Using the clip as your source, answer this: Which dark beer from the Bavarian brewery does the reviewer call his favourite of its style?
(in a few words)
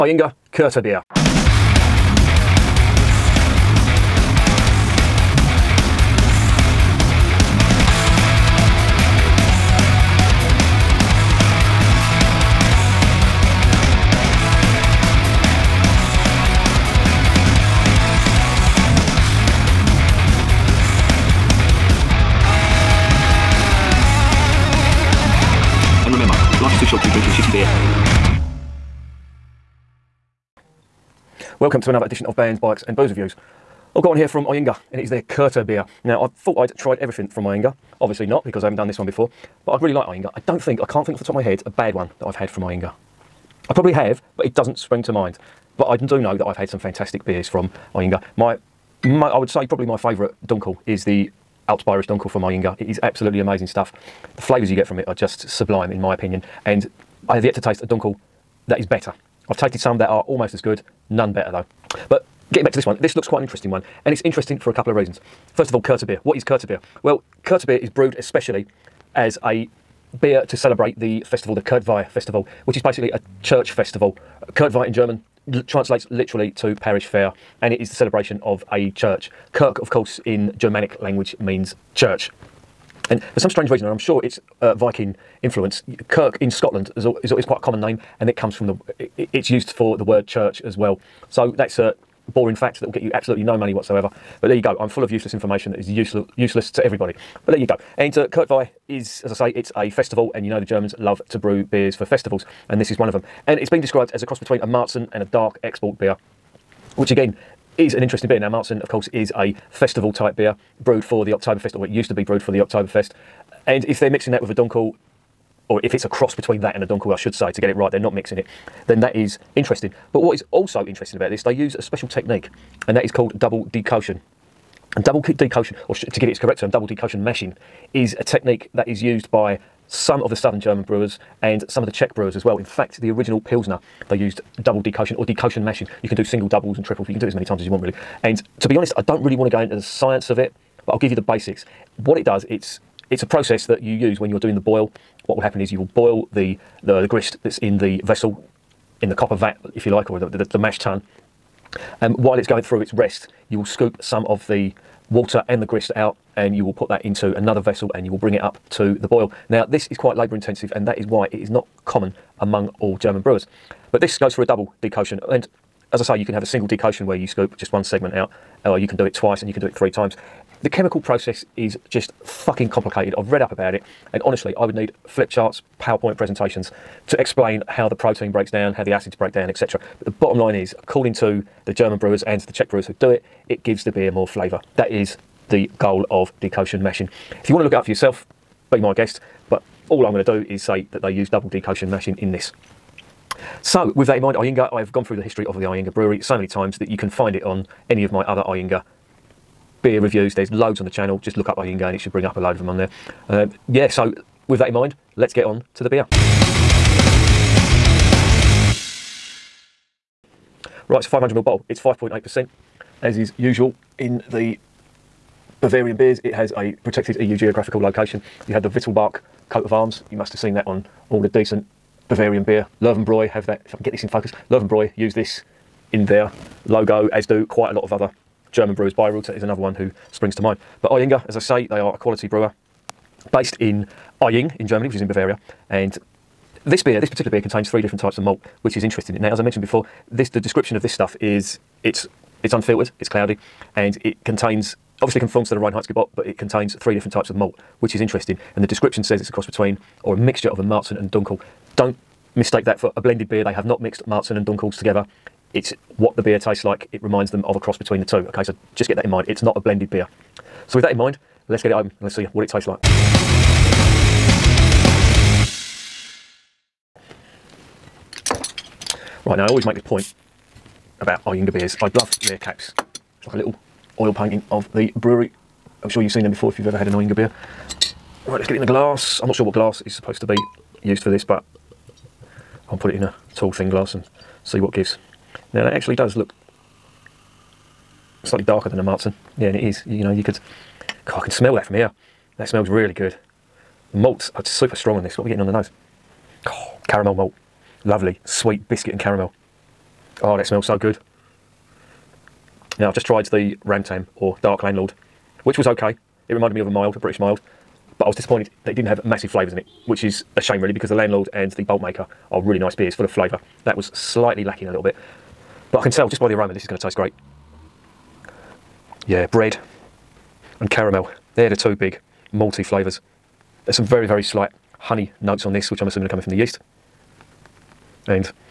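Altbairisch Dunkel.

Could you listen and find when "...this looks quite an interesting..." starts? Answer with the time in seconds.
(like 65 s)
63 s.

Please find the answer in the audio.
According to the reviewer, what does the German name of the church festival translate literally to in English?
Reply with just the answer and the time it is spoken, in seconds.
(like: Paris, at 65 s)
parish fair, at 76 s.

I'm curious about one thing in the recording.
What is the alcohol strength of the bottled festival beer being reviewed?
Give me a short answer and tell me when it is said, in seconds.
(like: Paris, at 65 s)
5.8%, at 211 s.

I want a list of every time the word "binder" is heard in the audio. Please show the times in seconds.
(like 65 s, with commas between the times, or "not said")
not said.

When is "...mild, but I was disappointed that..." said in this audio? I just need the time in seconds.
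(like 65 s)
307 s.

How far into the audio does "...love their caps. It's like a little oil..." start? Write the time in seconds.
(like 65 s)
271 s.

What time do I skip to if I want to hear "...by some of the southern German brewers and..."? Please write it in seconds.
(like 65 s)
129 s.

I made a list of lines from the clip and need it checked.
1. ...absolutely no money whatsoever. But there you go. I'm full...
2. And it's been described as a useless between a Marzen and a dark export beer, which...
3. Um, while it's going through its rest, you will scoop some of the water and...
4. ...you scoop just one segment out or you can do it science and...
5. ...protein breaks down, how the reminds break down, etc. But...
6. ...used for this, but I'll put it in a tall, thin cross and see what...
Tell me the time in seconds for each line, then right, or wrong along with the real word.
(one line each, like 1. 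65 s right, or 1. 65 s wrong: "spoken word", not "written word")
1. 93 s right
2. 103 s wrong: "cross", not "useless"
3. 152 s right
4. 167 s wrong: "twice", not "science"
5. 177 s wrong: "acids", not "reminds"
6. 280 s wrong: "glass", not "cross".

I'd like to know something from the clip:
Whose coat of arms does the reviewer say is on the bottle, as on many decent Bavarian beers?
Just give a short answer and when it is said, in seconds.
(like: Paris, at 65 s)
Wittelsbach, at 218 s.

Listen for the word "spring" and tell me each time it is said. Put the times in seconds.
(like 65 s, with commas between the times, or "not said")
44 s, 230 s.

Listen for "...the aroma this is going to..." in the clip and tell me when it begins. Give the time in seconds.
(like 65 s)
316 s.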